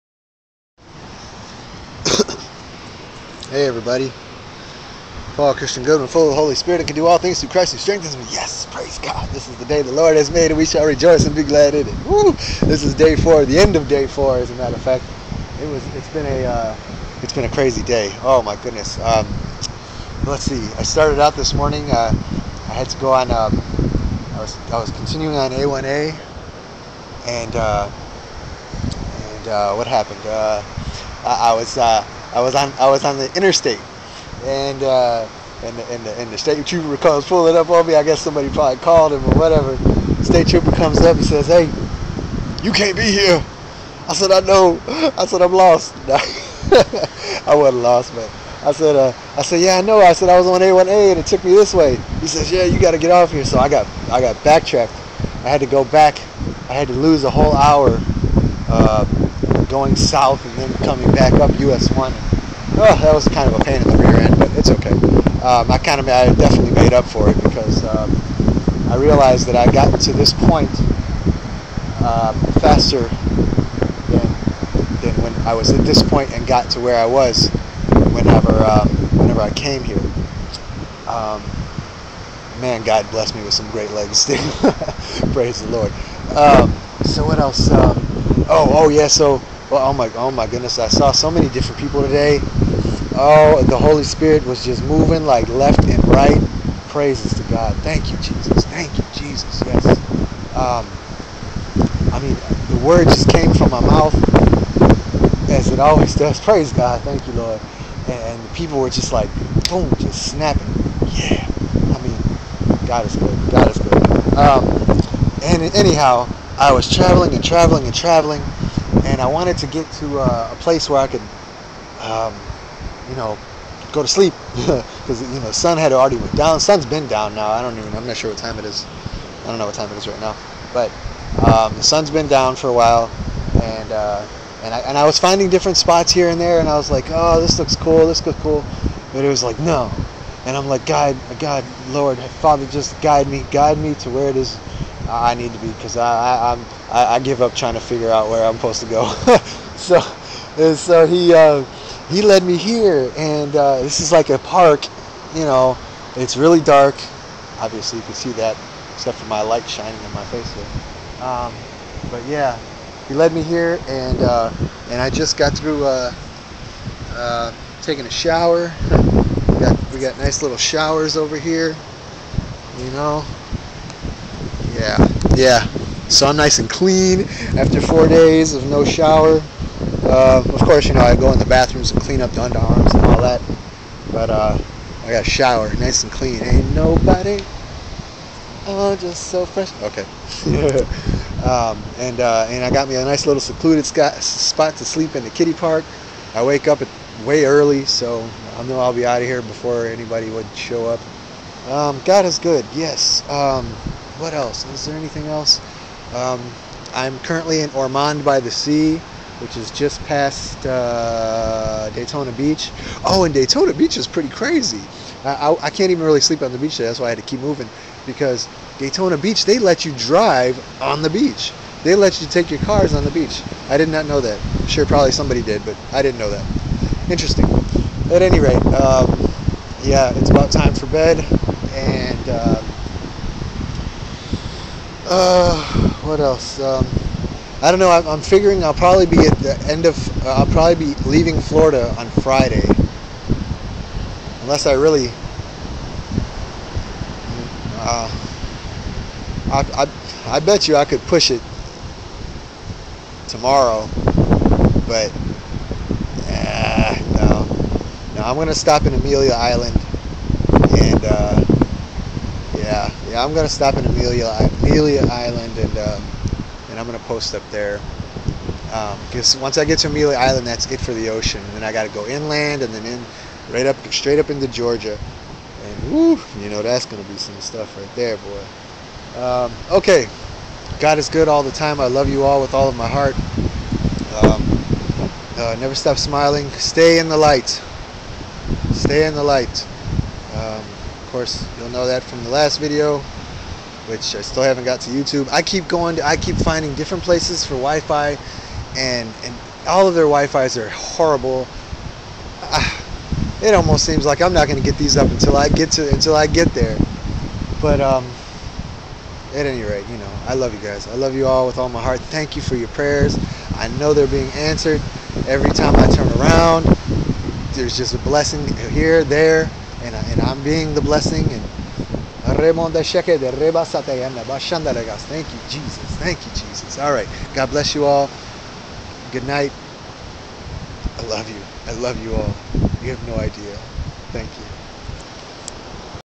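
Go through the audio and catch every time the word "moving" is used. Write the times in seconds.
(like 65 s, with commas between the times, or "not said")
94 s, 217 s.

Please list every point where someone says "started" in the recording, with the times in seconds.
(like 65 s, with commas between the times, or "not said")
20 s.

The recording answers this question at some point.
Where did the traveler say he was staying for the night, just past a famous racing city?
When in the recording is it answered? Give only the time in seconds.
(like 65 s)
207 s.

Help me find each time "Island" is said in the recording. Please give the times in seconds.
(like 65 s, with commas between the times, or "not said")
259 s, 265 s, 270 s.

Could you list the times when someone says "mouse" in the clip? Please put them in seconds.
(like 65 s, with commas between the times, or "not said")
not said.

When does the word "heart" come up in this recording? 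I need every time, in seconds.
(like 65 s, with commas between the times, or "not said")
282 s, 311 s.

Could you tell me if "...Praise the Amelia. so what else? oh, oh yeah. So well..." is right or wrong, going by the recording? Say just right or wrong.
wrong.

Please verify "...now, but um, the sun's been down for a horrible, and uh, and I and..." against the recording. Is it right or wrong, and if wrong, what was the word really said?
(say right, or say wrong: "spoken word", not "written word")
wrong: "while", not "horrible".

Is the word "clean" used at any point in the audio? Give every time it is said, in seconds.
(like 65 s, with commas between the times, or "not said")
176 s, 182 s, 186 s.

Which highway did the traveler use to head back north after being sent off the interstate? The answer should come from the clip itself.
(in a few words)
US 1.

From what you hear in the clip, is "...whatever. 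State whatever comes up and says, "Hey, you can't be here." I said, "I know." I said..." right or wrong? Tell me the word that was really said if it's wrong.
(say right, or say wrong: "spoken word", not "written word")
wrong: "trooper", not "whatever".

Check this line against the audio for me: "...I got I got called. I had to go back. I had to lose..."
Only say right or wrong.
wrong.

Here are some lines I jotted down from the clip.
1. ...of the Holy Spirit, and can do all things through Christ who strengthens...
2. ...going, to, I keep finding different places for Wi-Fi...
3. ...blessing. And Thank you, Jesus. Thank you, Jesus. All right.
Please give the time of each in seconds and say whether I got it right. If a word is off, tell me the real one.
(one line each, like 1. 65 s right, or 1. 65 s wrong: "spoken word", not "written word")
1. 6 s right
2. 295 s right
3. 320 s right.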